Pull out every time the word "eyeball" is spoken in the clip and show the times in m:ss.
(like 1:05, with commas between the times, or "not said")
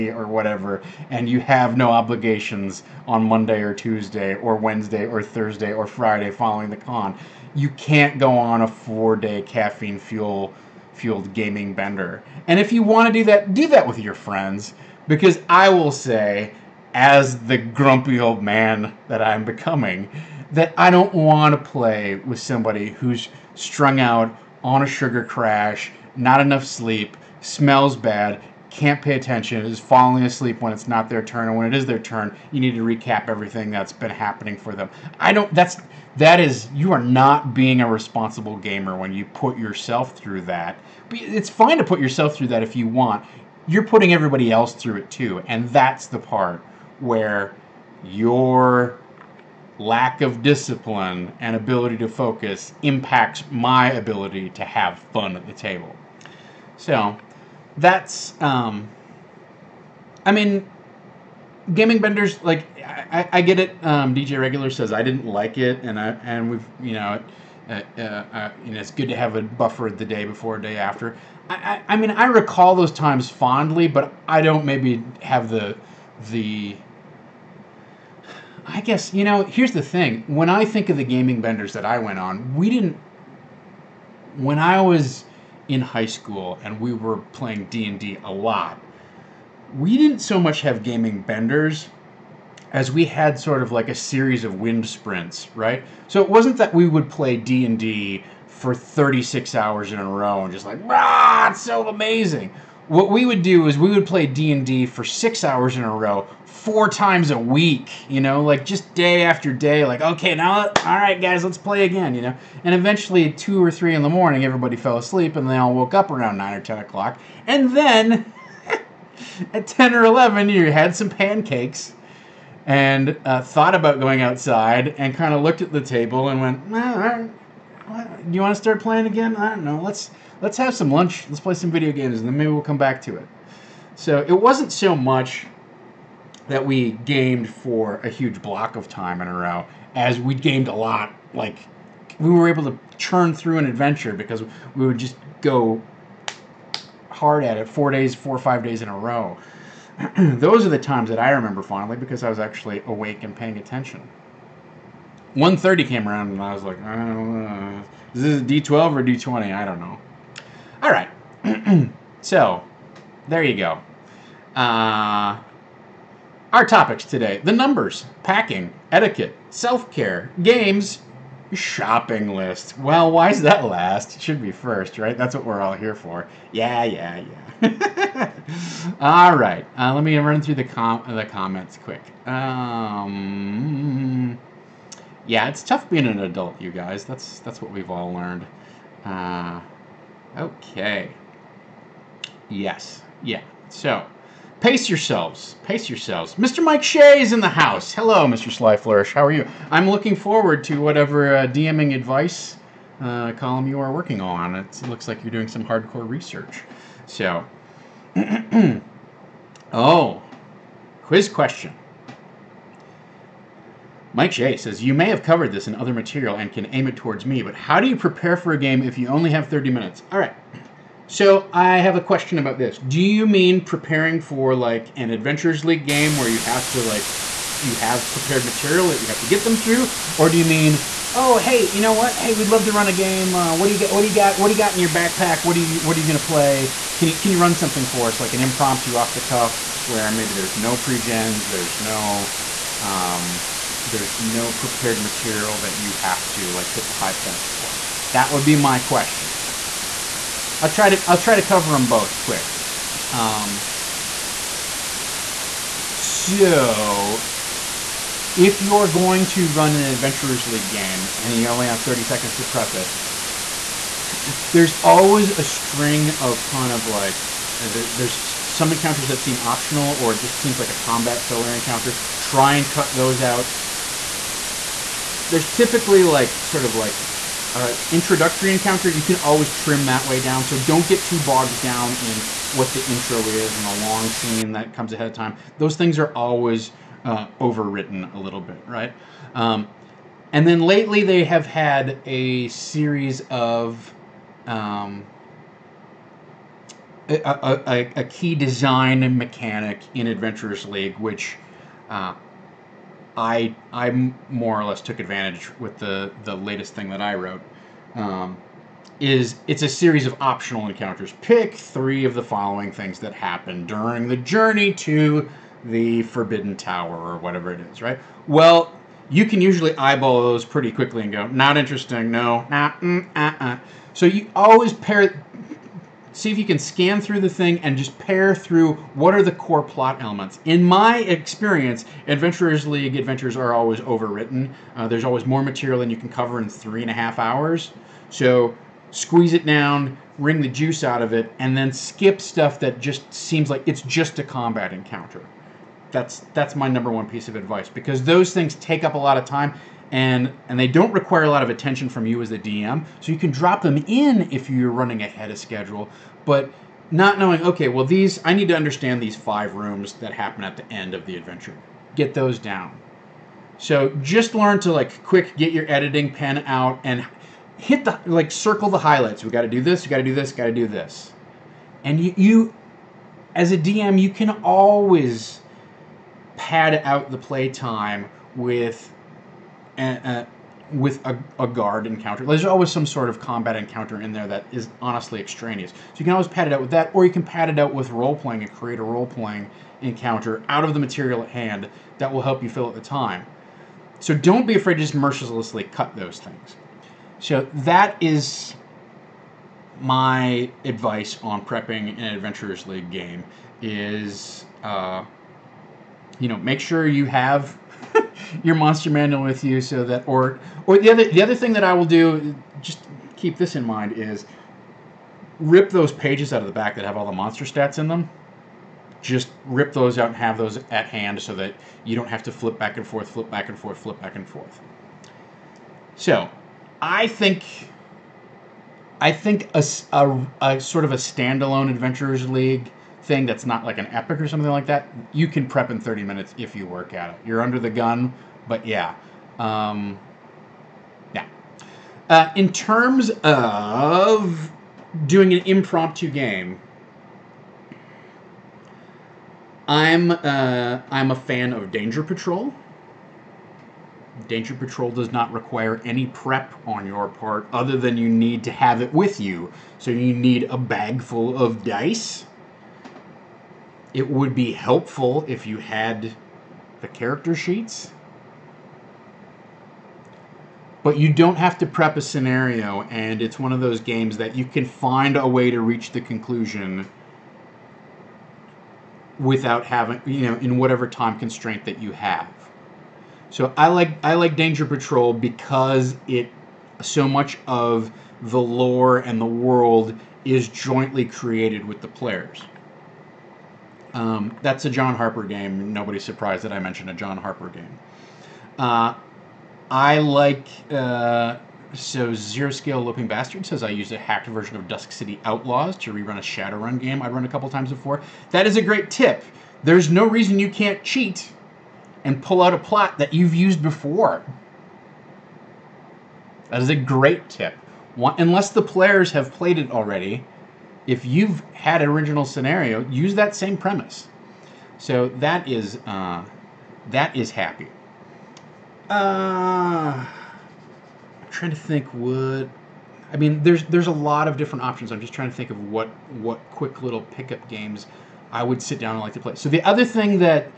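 5:19.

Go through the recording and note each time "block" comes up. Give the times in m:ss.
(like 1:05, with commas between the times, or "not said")
2:18.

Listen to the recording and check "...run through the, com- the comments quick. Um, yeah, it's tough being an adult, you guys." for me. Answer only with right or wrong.
right.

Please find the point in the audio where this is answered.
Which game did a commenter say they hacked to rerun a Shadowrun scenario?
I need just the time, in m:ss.
8:24.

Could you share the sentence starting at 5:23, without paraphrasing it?
So you always pair see if you can scan through the thing and just pair through what are the core plot elements.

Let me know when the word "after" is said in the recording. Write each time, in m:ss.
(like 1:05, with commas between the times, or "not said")
1:10, 1:49.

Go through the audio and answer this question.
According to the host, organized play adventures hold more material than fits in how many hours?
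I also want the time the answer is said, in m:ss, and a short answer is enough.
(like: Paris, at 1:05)
3.5, at 5:36.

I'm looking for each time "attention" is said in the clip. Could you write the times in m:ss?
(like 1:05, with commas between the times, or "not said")
0:29, 2:33, 5:51.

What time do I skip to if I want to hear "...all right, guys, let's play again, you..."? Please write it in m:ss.
1:50.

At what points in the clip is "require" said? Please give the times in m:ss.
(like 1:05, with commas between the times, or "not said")
5:50, 7:35.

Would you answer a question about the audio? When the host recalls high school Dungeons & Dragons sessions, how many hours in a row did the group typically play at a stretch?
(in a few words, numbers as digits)
6.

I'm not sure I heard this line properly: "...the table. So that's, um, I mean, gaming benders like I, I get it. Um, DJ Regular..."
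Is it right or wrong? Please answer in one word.
right.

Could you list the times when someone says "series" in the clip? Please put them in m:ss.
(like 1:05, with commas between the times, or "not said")
1:33, 4:52, 5:09.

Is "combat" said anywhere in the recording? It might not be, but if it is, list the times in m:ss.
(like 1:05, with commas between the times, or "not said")
4:30, 5:44, 6:23.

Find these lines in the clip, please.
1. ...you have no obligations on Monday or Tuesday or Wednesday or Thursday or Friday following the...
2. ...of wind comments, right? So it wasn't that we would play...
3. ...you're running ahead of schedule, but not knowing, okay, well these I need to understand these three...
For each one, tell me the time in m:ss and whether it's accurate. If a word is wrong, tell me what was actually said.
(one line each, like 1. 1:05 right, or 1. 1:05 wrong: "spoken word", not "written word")
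1. 0:01 right
2. 1:34 wrong: "sprints", not "comments"
3. 5:54 wrong: "five", not "three".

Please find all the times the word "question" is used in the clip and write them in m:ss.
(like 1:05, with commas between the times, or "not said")
3:31, 3:42, 4:08.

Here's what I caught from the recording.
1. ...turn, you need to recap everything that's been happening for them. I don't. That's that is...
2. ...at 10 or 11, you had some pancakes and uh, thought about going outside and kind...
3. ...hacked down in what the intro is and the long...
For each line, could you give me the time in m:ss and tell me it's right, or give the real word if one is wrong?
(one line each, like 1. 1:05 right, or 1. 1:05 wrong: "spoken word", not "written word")
1. 0:31 right
2. 1:59 right
3. 4:41 wrong: "bogged", not "hacked".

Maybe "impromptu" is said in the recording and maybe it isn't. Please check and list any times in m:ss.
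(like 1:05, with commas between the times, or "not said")
3:58, 7:25.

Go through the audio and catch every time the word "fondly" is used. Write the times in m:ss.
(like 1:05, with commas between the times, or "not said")
1:13, 2:31.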